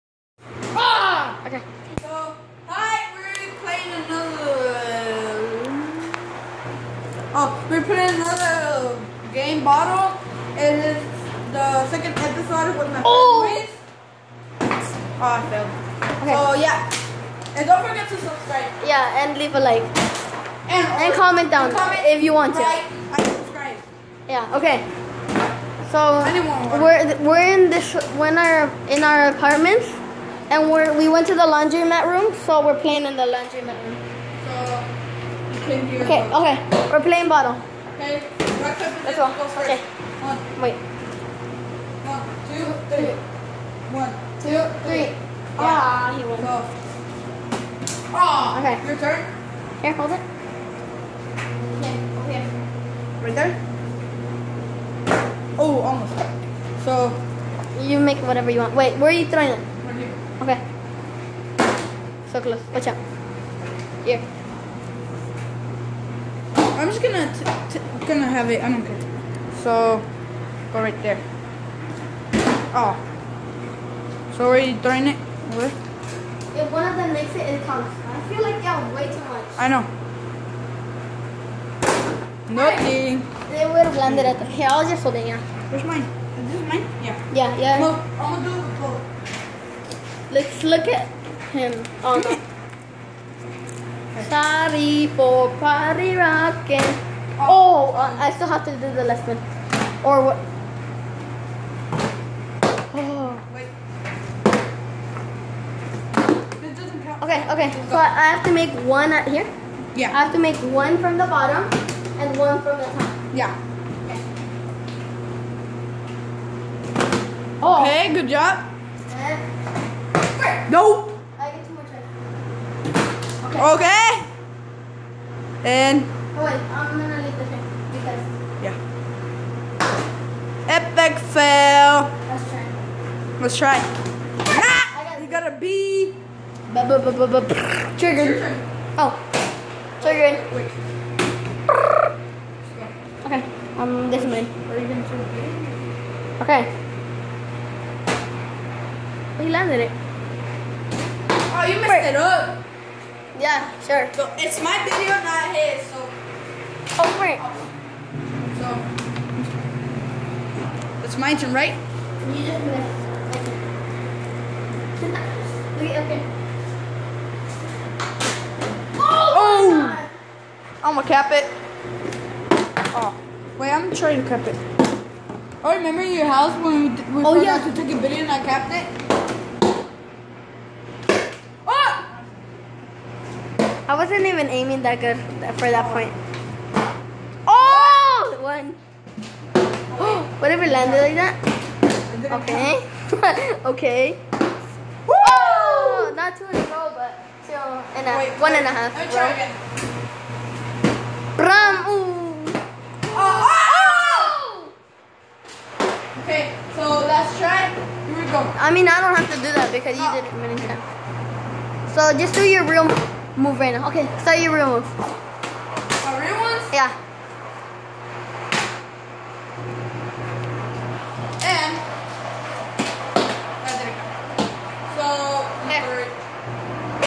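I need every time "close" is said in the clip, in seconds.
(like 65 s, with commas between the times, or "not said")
62 s.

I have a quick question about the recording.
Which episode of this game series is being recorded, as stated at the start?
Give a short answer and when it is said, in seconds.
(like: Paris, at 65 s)
Second, at 11 s.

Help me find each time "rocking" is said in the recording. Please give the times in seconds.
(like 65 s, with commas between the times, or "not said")
96 s.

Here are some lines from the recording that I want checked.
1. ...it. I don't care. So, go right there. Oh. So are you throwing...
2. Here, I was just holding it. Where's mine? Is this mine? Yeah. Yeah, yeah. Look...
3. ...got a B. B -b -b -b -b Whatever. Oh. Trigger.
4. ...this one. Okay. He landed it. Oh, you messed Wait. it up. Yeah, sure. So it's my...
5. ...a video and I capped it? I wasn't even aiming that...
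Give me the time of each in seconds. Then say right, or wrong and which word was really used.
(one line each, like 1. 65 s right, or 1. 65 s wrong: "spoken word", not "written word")
1. 68 s right
2. 84 s right
3. 135 s wrong: "Trigger", not "Whatever"
4. 144 s right
5. 177 s right.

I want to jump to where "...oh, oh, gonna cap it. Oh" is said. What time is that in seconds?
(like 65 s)
169 s.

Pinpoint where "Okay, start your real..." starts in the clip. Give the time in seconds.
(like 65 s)
213 s.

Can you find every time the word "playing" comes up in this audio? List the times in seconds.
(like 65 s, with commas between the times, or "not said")
32 s, 37 s.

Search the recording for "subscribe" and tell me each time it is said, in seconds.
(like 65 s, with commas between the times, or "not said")
18 s, 23 s.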